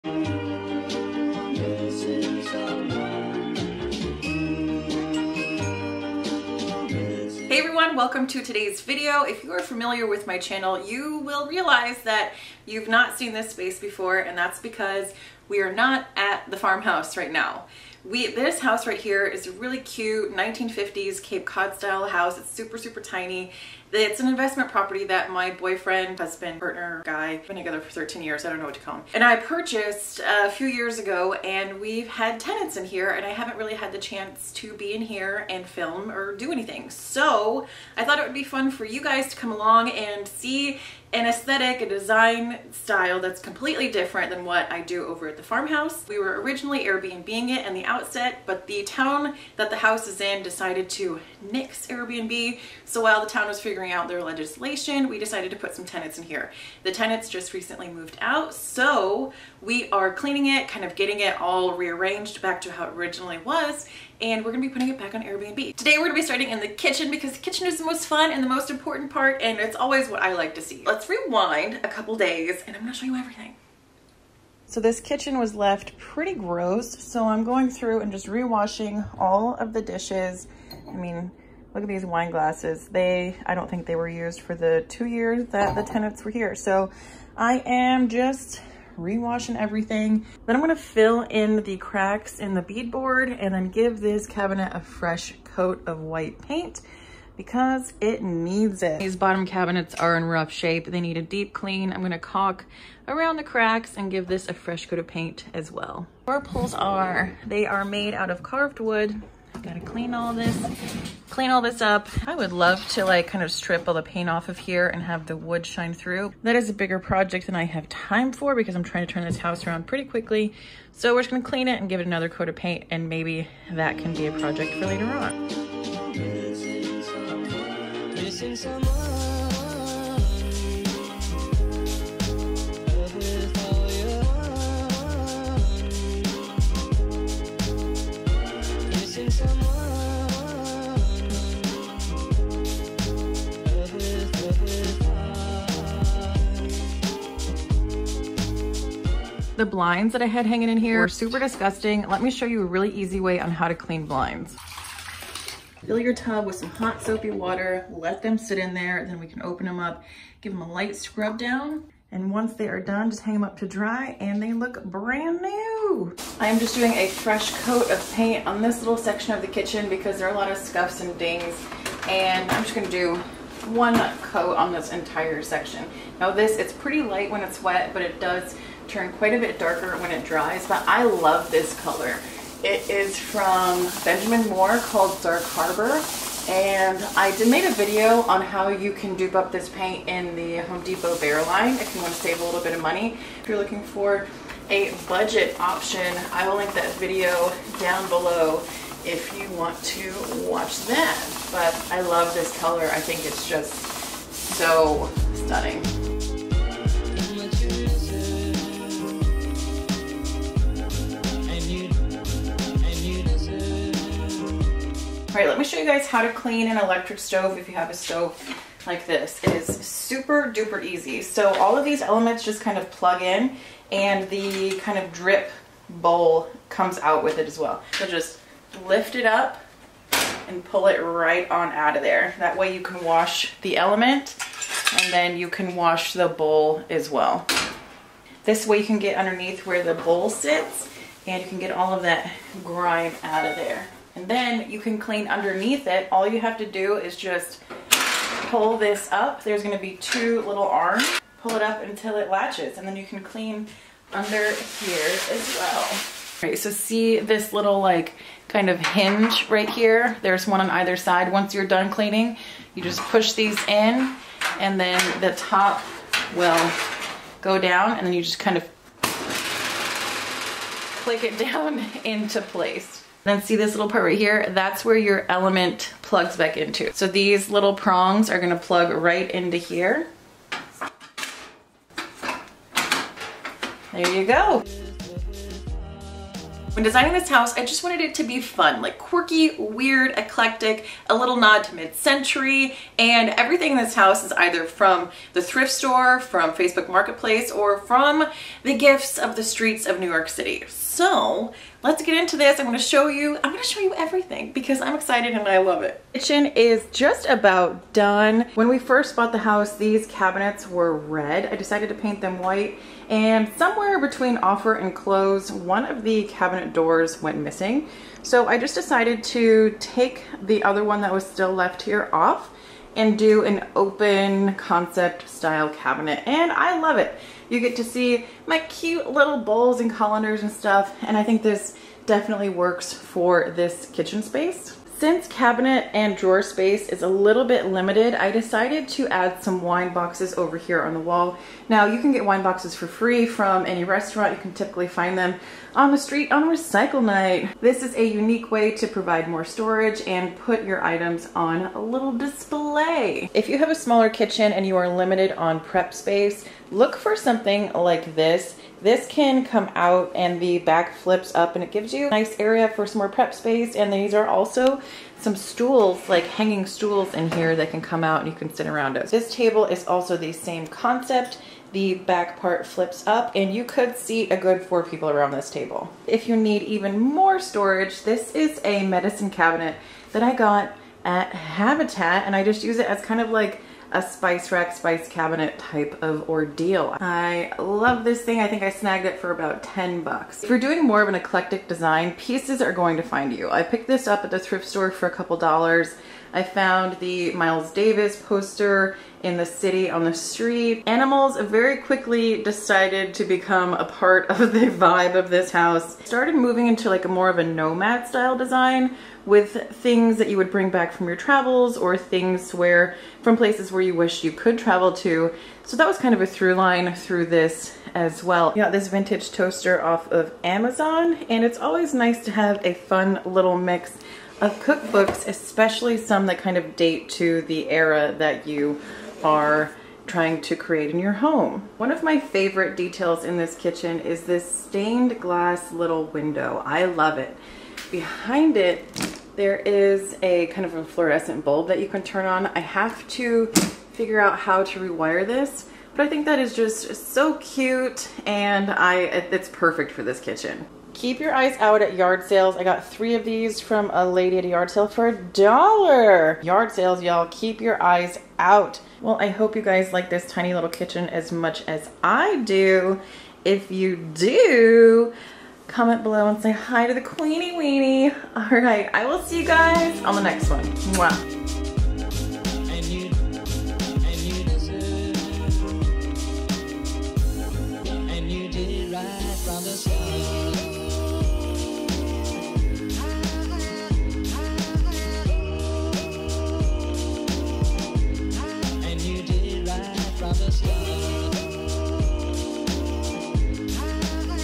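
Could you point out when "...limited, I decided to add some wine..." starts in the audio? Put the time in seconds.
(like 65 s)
337 s.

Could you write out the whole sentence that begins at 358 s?
This can come out and the back flips up and it gives you a nice area for some more prep space.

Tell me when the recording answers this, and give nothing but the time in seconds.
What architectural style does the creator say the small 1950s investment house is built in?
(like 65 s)
21 s.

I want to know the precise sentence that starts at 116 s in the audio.
That is a bigger project than I have time for because I'm trying to turn this house around pretty quickly.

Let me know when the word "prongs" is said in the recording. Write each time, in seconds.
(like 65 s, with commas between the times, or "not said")
277 s.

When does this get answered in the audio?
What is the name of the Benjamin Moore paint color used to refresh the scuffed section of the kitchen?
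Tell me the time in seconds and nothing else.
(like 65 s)
185 s.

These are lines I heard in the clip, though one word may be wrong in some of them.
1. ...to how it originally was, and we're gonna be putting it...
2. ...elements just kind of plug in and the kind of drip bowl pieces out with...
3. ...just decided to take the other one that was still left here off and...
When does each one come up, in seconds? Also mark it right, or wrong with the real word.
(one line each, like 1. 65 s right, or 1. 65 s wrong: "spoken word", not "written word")
1. 62 s right
2. 222 s wrong: "comes", not "pieces"
3. 318 s right.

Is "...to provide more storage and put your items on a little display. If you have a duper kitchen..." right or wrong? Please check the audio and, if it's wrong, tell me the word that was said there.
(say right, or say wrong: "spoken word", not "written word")
wrong: "smaller", not "duper".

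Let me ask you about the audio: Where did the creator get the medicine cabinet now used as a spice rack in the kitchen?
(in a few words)
Habitat.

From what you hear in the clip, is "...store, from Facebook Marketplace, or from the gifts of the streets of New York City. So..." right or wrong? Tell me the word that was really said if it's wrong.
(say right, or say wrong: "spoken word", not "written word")
right.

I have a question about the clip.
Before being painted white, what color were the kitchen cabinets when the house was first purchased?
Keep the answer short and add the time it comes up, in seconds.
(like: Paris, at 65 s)
red, at 310 s.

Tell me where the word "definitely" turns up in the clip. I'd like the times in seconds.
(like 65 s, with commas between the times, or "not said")
332 s.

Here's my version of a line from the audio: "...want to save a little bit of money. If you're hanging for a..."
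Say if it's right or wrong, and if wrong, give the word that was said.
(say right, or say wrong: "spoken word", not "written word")
wrong: "looking", not "hanging".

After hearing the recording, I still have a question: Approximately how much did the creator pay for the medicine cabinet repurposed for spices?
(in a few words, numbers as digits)
$10.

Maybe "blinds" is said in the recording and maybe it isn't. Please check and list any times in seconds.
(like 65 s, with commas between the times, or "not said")
149 s, 154 s.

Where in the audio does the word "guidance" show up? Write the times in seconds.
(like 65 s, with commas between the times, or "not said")
not said.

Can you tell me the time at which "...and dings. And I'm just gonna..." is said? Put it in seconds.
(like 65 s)
171 s.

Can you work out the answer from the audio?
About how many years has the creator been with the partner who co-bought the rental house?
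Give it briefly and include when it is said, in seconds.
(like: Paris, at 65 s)
13, at 27 s.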